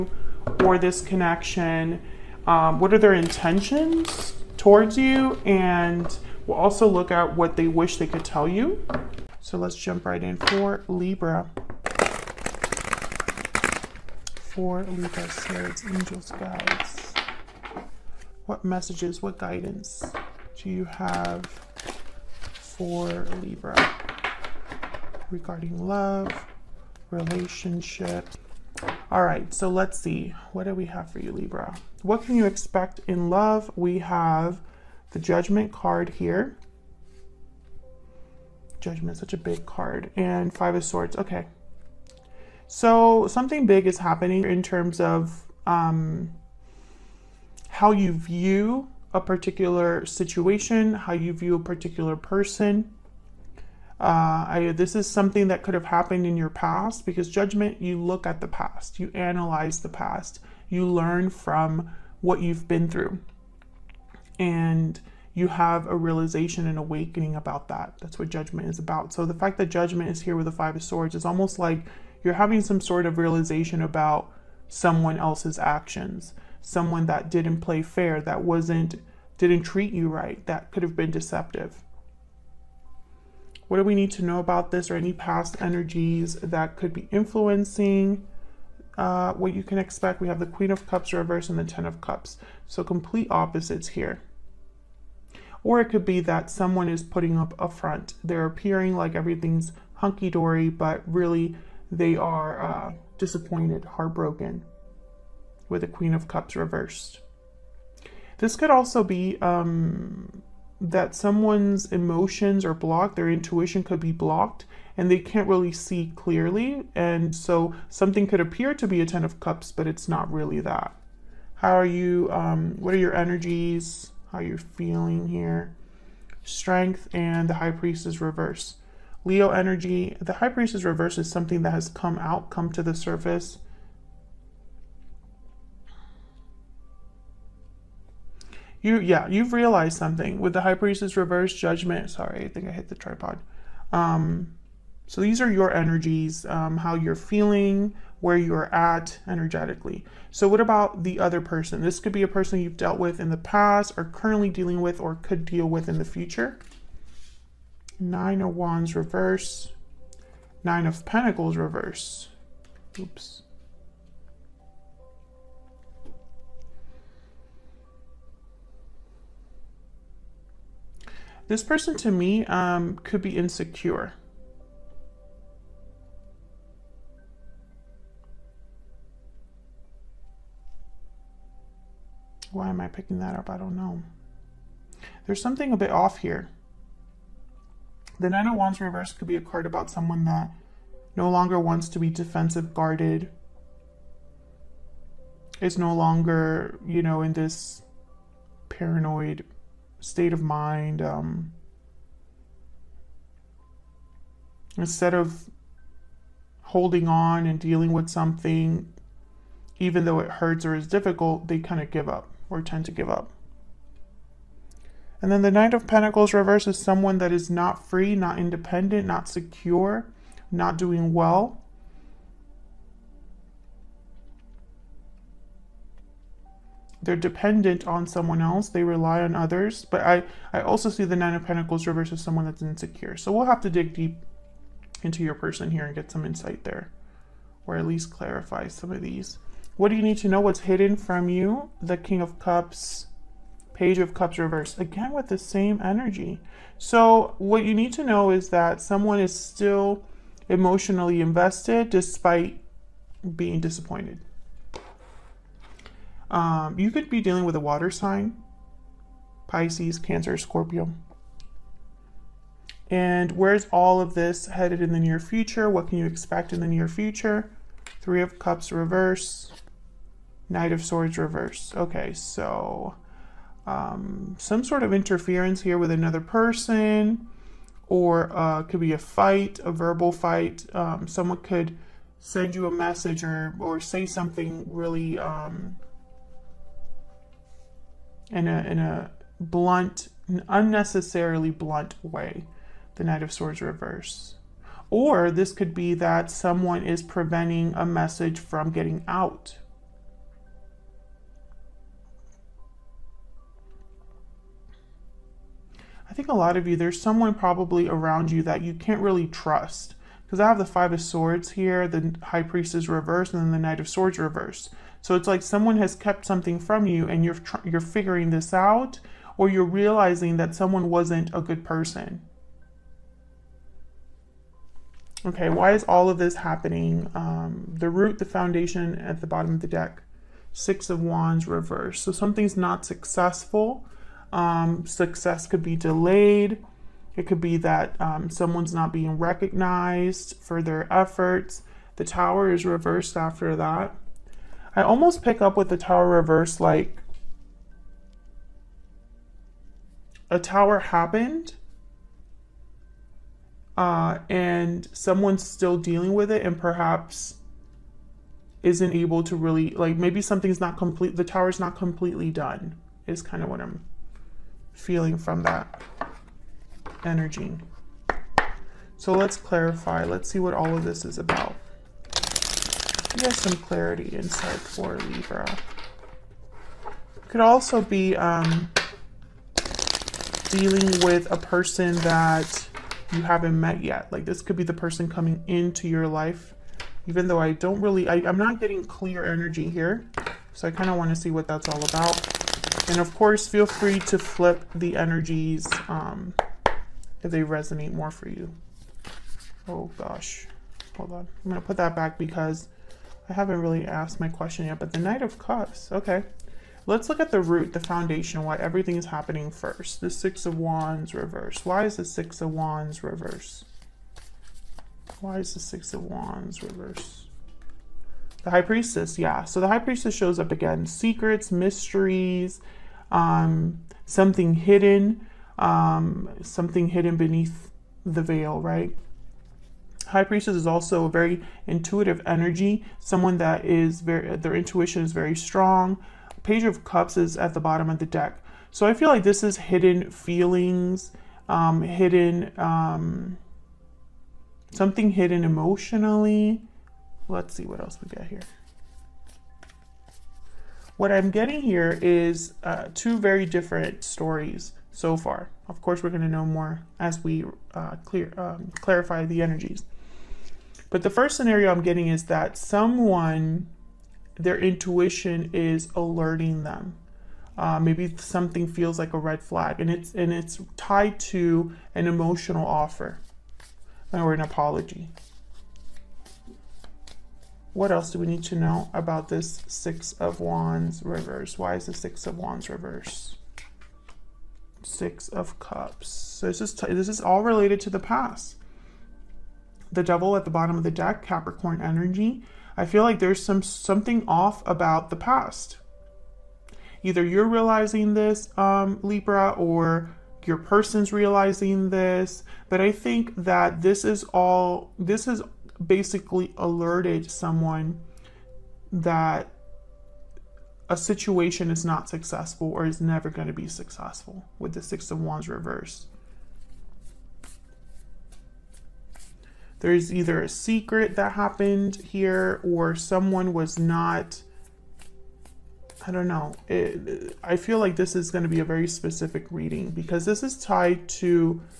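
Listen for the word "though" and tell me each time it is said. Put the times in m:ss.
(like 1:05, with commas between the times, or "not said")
3:30, 6:27.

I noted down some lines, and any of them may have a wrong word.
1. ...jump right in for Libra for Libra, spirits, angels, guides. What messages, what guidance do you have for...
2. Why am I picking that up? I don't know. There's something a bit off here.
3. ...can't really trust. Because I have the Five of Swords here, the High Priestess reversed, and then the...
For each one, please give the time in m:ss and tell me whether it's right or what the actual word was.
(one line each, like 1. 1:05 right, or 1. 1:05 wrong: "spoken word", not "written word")
1. 0:09 right
2. 3:02 right
3. 5:08 right.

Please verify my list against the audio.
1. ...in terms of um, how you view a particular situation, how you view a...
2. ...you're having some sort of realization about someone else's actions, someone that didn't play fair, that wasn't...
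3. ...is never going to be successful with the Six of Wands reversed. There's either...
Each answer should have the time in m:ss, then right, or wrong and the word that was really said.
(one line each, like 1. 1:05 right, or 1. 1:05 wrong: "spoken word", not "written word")
1. 0:44 right
2. 1:12 right
3. 8:32 right.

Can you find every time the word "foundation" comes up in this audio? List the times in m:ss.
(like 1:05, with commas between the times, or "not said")
5:28, 6:47.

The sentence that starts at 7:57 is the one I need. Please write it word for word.
What else do we need to know about this Six of Wands reverse?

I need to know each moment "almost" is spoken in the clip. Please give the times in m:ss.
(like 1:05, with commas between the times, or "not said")
1:11, 5:44.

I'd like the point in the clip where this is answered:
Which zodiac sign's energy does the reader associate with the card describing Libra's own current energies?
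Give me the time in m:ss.
2:09.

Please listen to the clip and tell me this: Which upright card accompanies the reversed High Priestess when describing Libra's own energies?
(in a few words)
Strength.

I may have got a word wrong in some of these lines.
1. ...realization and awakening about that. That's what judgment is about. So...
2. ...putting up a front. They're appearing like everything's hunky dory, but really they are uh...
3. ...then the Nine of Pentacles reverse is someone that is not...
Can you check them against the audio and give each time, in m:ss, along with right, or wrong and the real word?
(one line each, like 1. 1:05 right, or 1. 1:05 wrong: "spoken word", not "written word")
1. 1:05 right
2. 1:37 right
3. 3:35 right.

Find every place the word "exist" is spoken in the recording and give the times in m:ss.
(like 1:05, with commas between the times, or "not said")
not said.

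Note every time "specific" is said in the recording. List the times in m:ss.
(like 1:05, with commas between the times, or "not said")
8:48.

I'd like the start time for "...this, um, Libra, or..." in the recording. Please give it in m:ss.
8:18.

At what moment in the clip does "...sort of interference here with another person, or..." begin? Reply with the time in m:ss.
4:34.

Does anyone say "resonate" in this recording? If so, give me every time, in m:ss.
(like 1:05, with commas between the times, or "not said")
6:37.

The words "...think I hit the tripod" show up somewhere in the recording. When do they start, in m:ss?
2:22.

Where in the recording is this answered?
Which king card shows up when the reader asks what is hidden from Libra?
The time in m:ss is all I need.
4:01.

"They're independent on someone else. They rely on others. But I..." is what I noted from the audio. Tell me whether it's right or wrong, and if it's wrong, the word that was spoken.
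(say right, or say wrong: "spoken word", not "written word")
wrong: "dependent", not "independent".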